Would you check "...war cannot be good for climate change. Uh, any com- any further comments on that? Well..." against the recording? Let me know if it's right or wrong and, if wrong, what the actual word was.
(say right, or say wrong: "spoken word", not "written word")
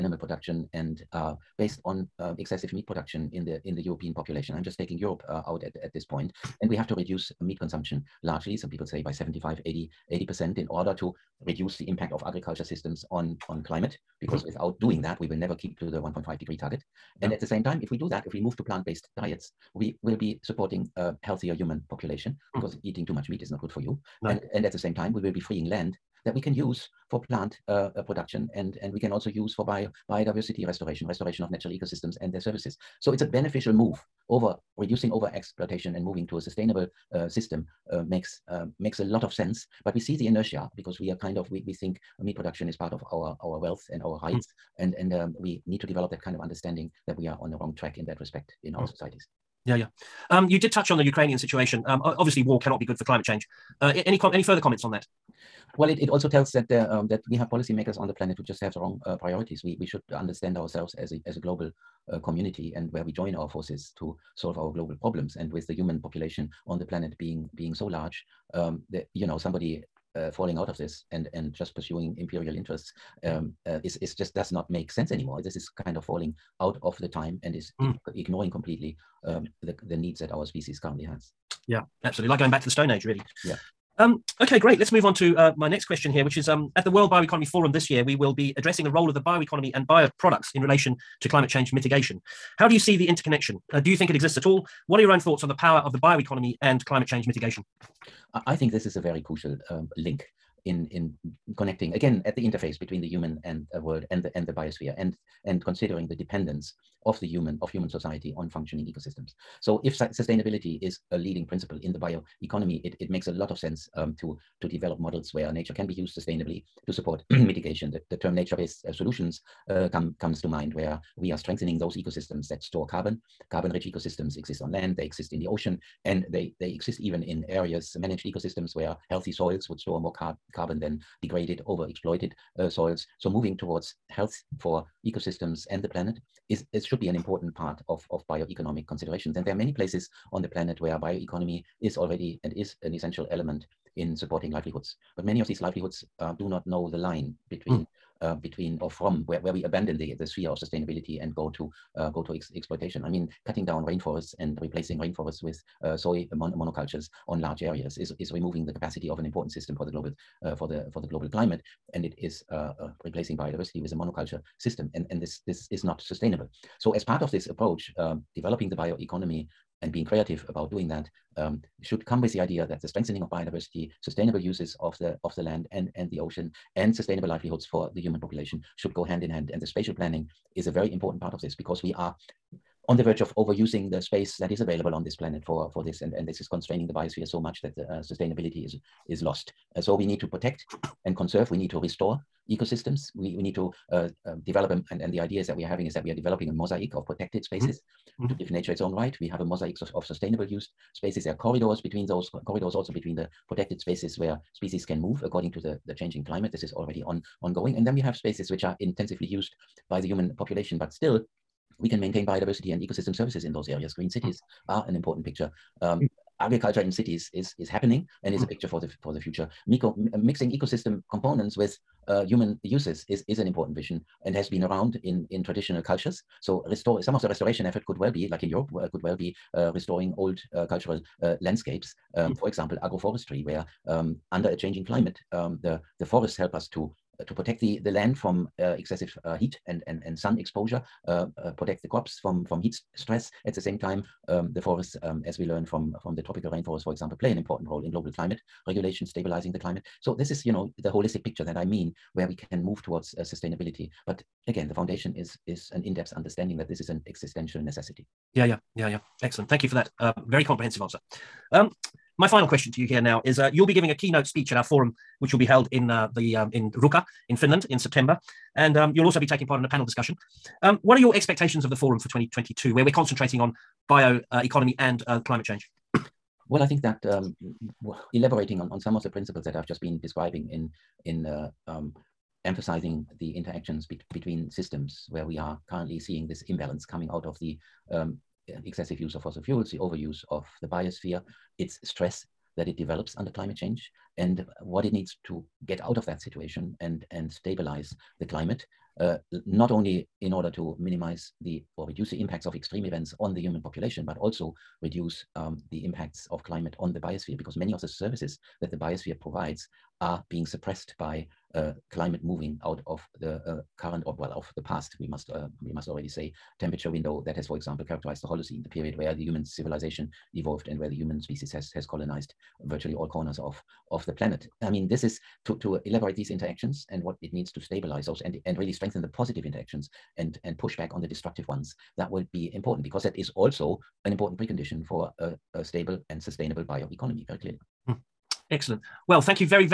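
right.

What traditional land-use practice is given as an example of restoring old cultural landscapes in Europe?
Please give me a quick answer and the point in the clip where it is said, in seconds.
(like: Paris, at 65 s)
Agroforestry, at 232 s.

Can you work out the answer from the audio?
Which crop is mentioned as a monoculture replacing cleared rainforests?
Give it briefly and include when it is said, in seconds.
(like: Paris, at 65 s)
Soy, at 155 s.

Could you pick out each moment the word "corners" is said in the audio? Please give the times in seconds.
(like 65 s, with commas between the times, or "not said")
323 s.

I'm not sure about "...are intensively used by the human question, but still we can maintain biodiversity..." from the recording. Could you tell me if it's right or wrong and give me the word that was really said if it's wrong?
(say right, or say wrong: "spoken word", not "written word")
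wrong: "population", not "question".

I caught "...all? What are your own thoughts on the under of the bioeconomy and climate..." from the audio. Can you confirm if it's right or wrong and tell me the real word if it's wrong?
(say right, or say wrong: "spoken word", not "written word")
wrong: "power", not "under".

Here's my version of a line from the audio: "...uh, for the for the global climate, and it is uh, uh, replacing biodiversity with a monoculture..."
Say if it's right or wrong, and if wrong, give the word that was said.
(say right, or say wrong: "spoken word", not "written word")
right.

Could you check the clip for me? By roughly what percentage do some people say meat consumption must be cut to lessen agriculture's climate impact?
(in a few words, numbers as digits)
75-80%.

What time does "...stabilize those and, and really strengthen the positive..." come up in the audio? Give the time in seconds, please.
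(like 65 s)
327 s.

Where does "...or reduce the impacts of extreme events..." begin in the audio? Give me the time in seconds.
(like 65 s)
301 s.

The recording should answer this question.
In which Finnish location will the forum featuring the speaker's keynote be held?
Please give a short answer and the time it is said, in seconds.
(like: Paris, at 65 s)
Ruka, at 266 s.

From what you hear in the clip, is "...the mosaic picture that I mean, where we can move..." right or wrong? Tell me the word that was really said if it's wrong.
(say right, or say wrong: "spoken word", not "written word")
wrong: "holistic", not "mosaic".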